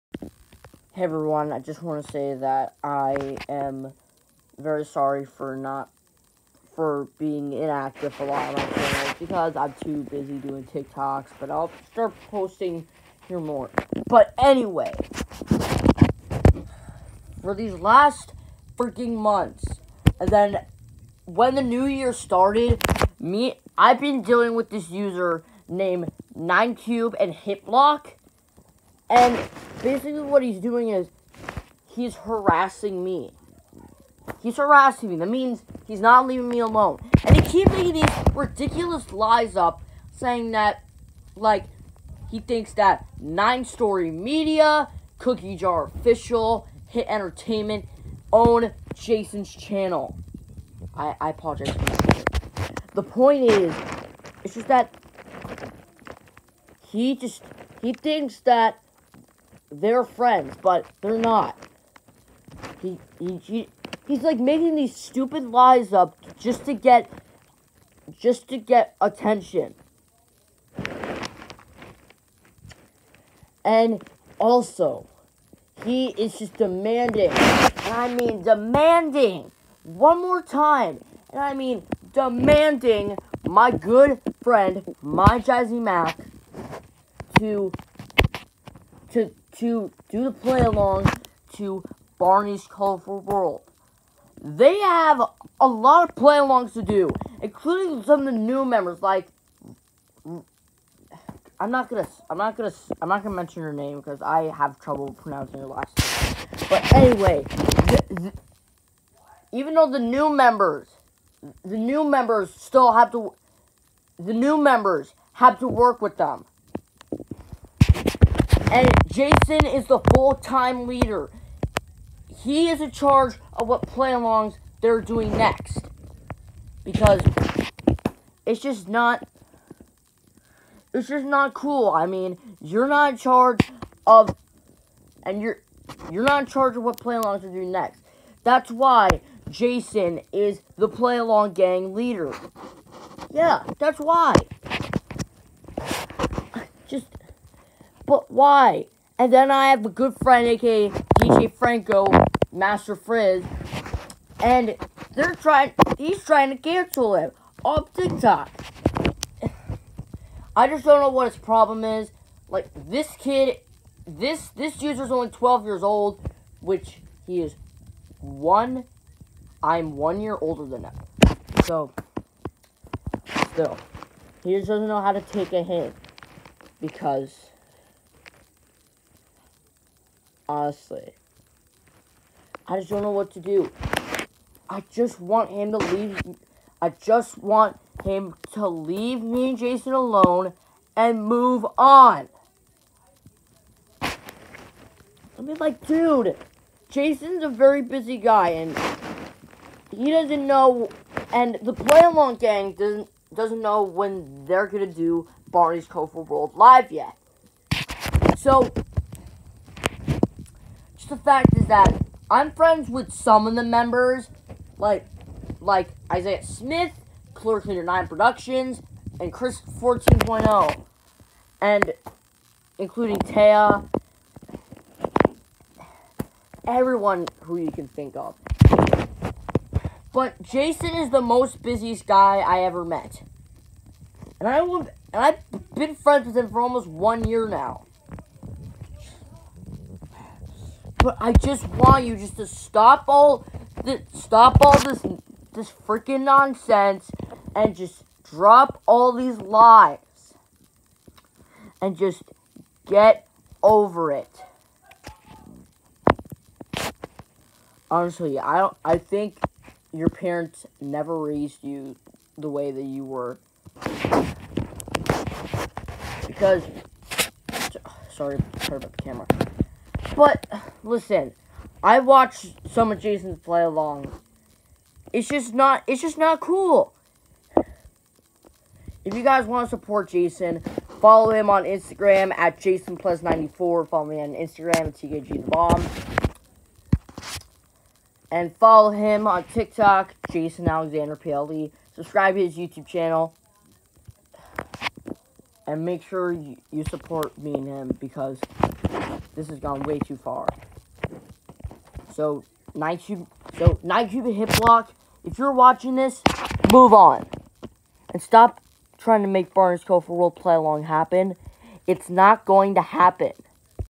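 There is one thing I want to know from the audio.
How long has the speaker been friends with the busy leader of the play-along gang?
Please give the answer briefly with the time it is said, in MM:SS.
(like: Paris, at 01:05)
almost 1 year, at 03:56.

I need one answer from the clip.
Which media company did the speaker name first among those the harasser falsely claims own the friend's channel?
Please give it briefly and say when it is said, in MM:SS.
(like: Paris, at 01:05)
Nine Story Media, at 00:43.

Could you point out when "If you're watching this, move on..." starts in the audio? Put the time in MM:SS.
05:05.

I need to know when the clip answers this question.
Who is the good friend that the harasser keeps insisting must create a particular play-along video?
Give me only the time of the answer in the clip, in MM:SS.
01:25.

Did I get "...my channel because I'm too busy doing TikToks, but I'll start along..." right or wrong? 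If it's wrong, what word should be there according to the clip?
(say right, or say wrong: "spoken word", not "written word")
wrong: "posting", not "along".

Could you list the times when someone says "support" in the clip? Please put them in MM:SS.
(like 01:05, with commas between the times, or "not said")
04:39, 04:56.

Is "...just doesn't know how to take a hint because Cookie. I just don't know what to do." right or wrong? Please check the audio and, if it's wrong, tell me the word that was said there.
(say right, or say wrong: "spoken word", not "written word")
wrong: "Honestly", not "Cookie".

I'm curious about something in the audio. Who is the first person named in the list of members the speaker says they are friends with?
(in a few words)
Isaiah Smith.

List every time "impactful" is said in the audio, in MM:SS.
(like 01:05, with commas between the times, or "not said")
not said.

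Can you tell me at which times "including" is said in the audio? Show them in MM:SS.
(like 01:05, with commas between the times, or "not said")
01:37, 03:42.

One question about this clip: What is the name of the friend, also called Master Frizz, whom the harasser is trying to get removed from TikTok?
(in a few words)
DJ Franco.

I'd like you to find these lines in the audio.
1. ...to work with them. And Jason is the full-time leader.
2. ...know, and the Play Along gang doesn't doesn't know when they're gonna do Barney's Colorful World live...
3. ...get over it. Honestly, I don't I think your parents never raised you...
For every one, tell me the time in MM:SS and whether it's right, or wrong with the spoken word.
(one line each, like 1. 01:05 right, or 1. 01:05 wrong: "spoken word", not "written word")
1. 01:55 right
2. 03:20 right
3. 04:12 right.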